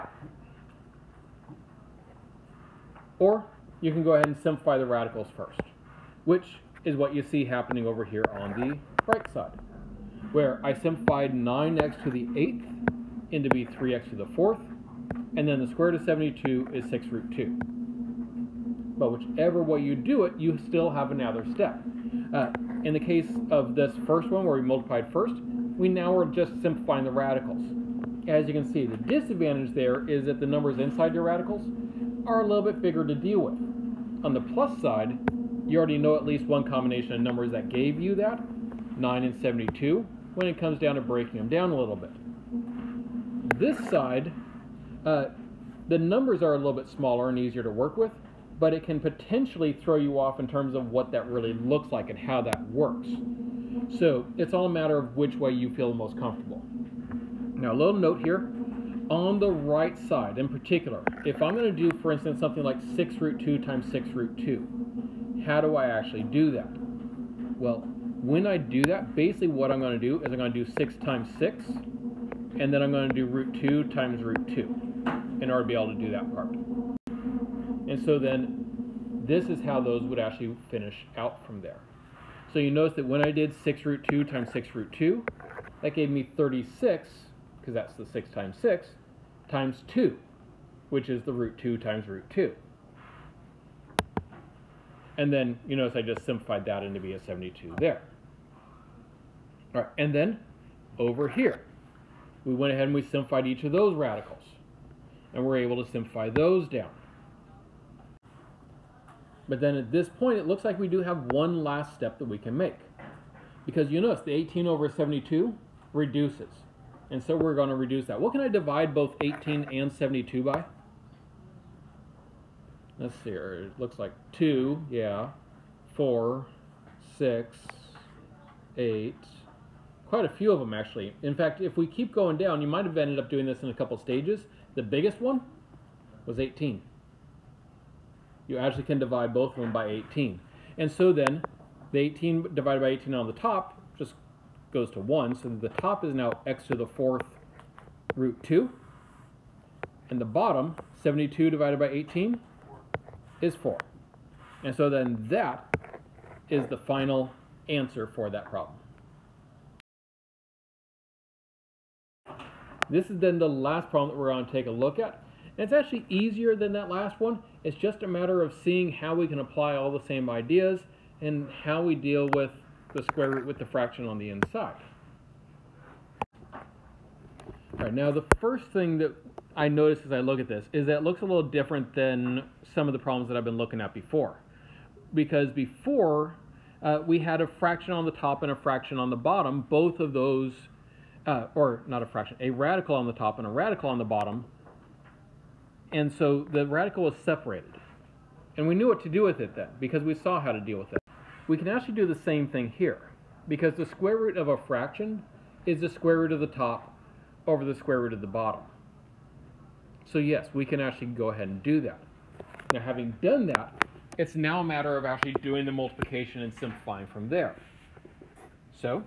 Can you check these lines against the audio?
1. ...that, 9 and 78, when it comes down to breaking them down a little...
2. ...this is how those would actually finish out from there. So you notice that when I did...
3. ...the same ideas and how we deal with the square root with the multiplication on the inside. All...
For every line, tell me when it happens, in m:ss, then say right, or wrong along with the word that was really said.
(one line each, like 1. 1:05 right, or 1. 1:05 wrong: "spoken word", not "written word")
1. 0:38 wrong: "72", not "78"
2. 1:19 right
3. 2:49 wrong: "fraction", not "multiplication".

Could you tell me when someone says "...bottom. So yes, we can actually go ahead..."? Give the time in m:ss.
3:28.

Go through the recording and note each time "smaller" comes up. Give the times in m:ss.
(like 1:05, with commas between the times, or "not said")
0:46.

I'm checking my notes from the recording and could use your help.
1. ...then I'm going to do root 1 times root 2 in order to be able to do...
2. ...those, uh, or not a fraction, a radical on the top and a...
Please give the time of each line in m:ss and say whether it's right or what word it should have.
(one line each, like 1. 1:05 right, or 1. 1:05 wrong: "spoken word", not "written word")
1. 1:12 wrong: "2", not "1"
2. 3:10 right.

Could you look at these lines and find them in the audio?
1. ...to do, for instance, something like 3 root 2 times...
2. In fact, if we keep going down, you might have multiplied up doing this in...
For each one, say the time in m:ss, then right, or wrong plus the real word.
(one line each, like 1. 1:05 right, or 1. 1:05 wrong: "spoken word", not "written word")
1. 1:01 wrong: "6", not "3"
2. 2:11 wrong: "ended", not "multiplied".